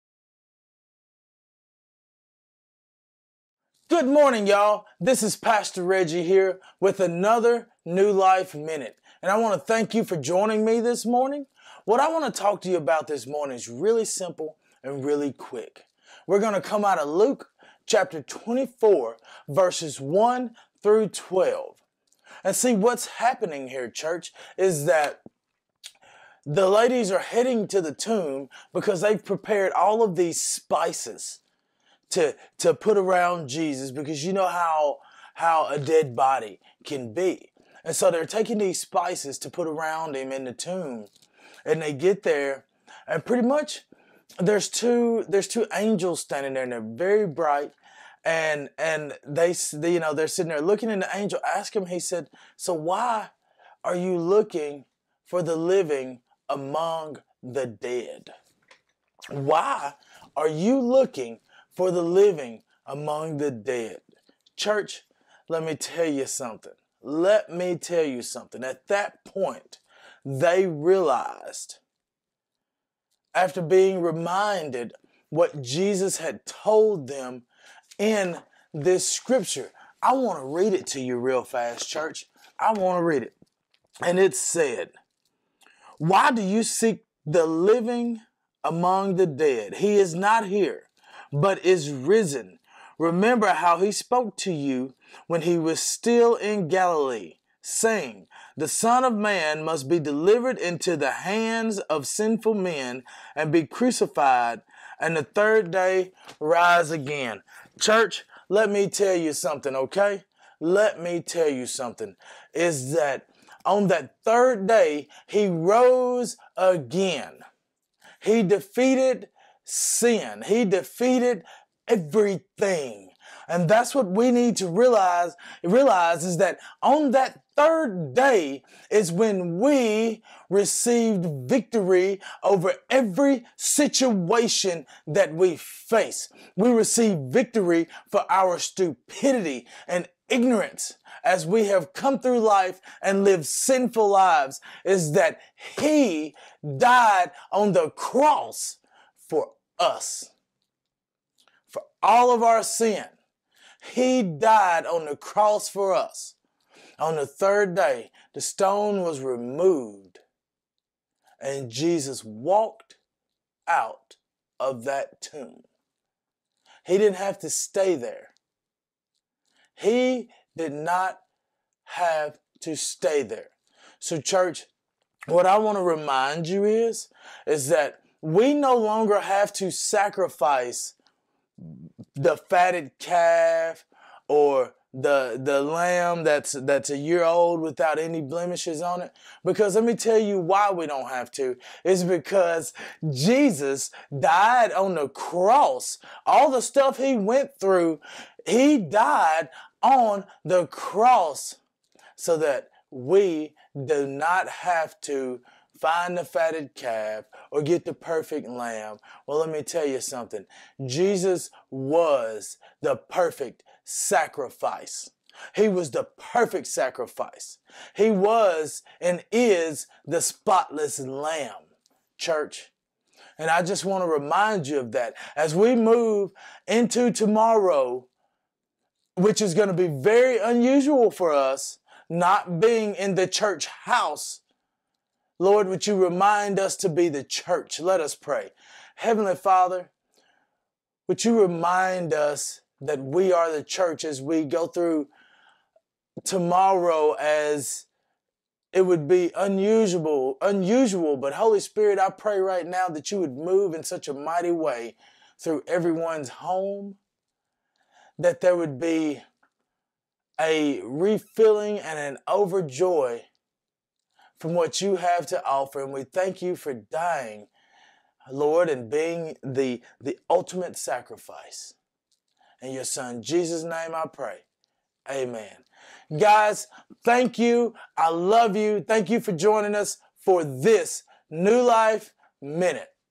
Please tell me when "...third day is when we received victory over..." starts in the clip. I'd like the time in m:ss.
2:07.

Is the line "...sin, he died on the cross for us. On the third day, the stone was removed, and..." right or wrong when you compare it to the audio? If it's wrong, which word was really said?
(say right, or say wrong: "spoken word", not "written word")
right.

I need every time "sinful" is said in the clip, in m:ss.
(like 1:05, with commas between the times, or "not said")
1:42, 2:23.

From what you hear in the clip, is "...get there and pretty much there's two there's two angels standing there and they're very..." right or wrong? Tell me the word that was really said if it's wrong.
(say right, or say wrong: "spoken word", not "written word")
right.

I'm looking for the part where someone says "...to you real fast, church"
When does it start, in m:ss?
1:20.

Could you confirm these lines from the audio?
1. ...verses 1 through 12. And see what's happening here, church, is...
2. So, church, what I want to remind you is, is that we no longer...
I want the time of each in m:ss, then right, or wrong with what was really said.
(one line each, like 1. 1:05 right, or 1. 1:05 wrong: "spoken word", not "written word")
1. 0:19 right
2. 2:53 right.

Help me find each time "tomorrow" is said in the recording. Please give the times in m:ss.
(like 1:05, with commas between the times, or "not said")
3:47, 4:06.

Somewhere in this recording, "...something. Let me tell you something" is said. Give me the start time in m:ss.
1:06.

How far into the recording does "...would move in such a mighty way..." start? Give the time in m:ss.
4:13.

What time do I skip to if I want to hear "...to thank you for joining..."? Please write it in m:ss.
0:09.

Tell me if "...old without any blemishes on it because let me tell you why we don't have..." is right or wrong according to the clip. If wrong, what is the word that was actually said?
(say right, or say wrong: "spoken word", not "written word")
right.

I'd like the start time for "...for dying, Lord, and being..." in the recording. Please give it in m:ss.
4:26.